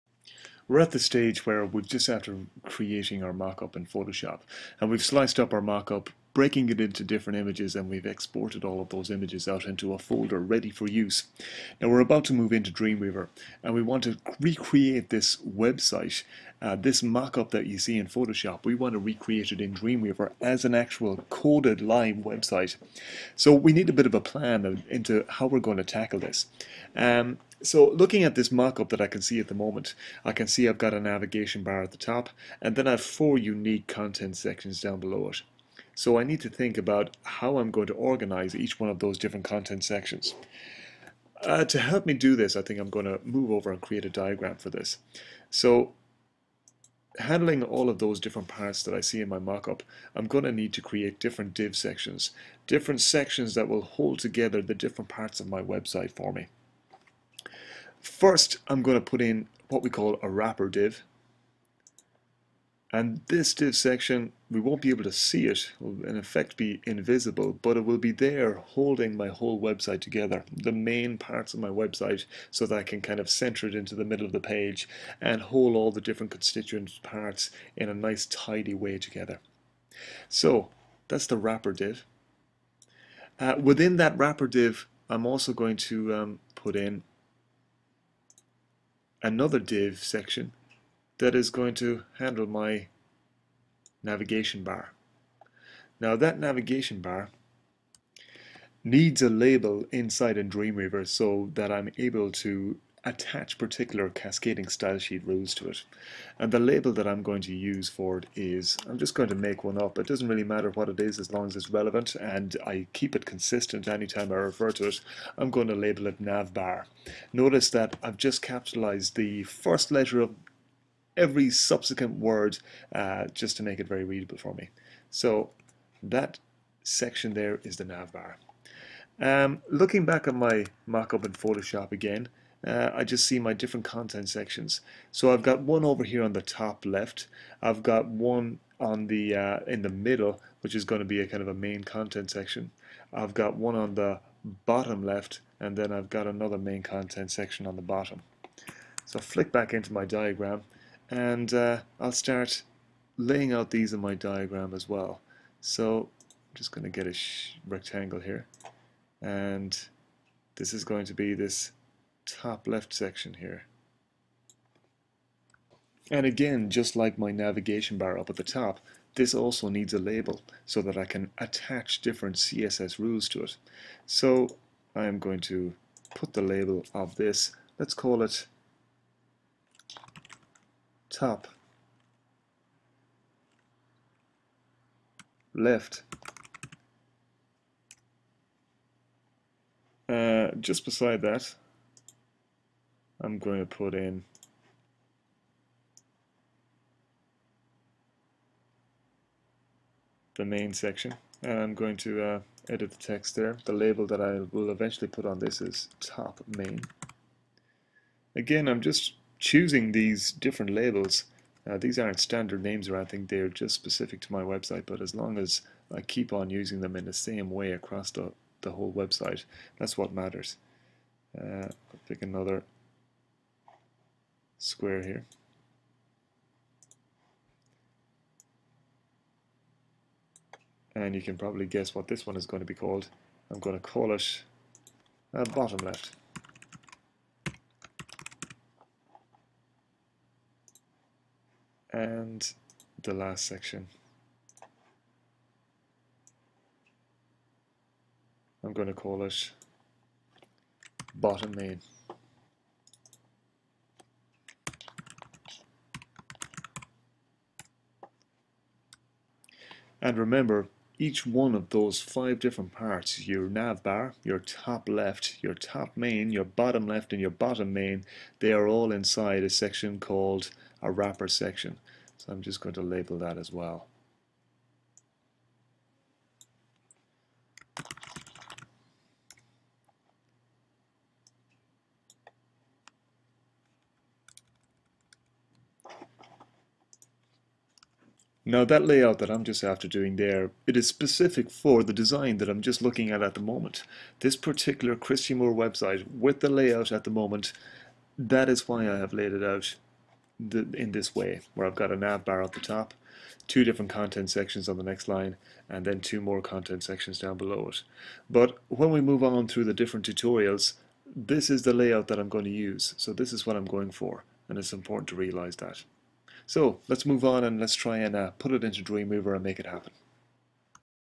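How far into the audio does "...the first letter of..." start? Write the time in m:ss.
1:59.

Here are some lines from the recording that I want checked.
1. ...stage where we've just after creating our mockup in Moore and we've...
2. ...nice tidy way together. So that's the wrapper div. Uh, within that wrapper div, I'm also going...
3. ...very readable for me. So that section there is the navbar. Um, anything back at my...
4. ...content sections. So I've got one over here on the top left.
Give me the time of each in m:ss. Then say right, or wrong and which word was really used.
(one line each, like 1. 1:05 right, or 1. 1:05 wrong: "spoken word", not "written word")
1. 0:00 wrong: "Photoshop", not "Moore"
2. 1:17 right
3. 2:03 wrong: "looking", not "anything"
4. 2:13 right.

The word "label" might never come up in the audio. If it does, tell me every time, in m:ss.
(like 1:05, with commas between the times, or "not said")
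1:39, 1:46, 1:55, 2:49, 2:56, 3:23, 3:30, 4:32.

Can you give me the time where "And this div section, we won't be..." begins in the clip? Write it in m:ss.
1:02.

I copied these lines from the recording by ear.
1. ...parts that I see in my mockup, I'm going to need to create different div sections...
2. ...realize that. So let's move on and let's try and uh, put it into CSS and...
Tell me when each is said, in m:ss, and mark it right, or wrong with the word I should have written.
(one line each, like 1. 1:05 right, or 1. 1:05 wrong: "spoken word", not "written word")
1. 0:48 right
2. 5:15 wrong: "Dreamweaver", not "CSS".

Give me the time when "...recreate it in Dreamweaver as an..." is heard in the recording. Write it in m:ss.
0:18.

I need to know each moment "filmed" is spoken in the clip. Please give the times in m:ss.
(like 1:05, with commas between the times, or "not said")
not said.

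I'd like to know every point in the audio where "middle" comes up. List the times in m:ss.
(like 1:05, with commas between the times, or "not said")
1:14, 2:19.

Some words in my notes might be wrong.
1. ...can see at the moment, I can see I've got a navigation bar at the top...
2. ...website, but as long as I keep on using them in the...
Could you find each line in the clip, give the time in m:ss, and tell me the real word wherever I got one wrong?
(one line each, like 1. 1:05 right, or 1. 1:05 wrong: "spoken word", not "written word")
1. 0:29 right
2. 3:34 right.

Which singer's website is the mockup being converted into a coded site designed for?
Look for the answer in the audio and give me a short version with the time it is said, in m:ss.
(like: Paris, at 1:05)
Christy Moore, at 4:54.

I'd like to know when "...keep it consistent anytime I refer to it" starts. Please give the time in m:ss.
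1:52.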